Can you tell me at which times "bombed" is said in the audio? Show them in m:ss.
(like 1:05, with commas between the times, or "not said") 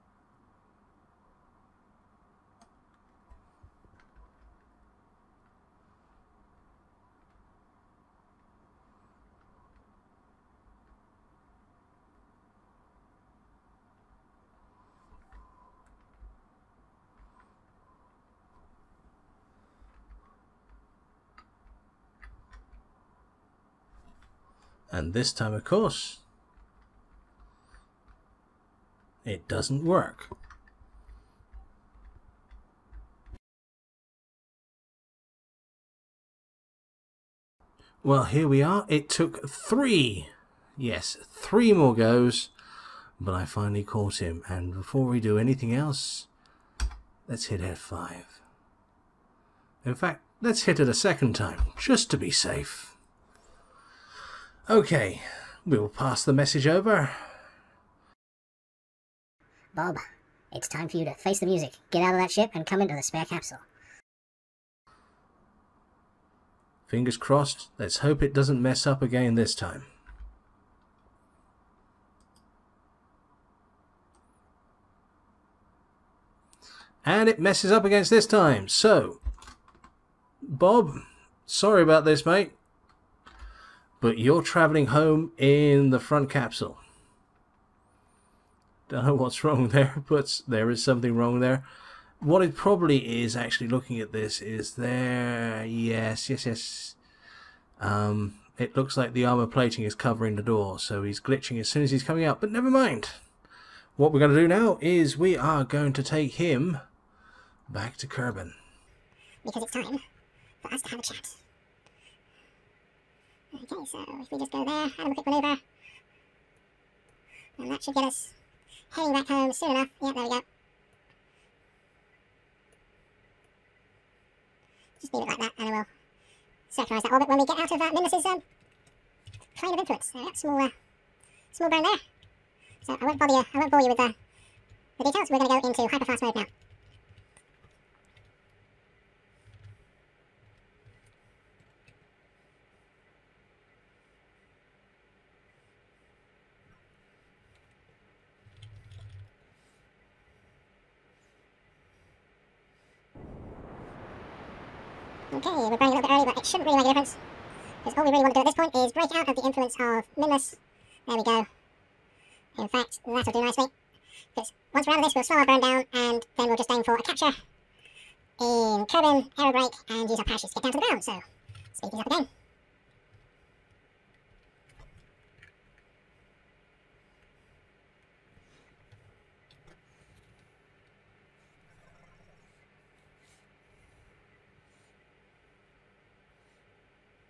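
not said.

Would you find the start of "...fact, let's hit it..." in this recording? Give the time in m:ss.
0:49.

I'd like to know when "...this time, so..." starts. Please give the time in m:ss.
1:18.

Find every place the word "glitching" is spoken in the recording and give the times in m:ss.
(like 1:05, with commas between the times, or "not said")
1:41.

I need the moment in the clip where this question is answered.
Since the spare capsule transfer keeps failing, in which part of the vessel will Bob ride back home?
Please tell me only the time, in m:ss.
1:25.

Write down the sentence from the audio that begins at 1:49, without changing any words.
Because it's time for us to have a chat.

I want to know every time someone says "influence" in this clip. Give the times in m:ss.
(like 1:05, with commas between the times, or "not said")
2:09, 2:39.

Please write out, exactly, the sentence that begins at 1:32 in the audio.
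What it probably is, actually looking at this, is there...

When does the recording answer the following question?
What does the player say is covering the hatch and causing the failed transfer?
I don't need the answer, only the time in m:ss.
1:39.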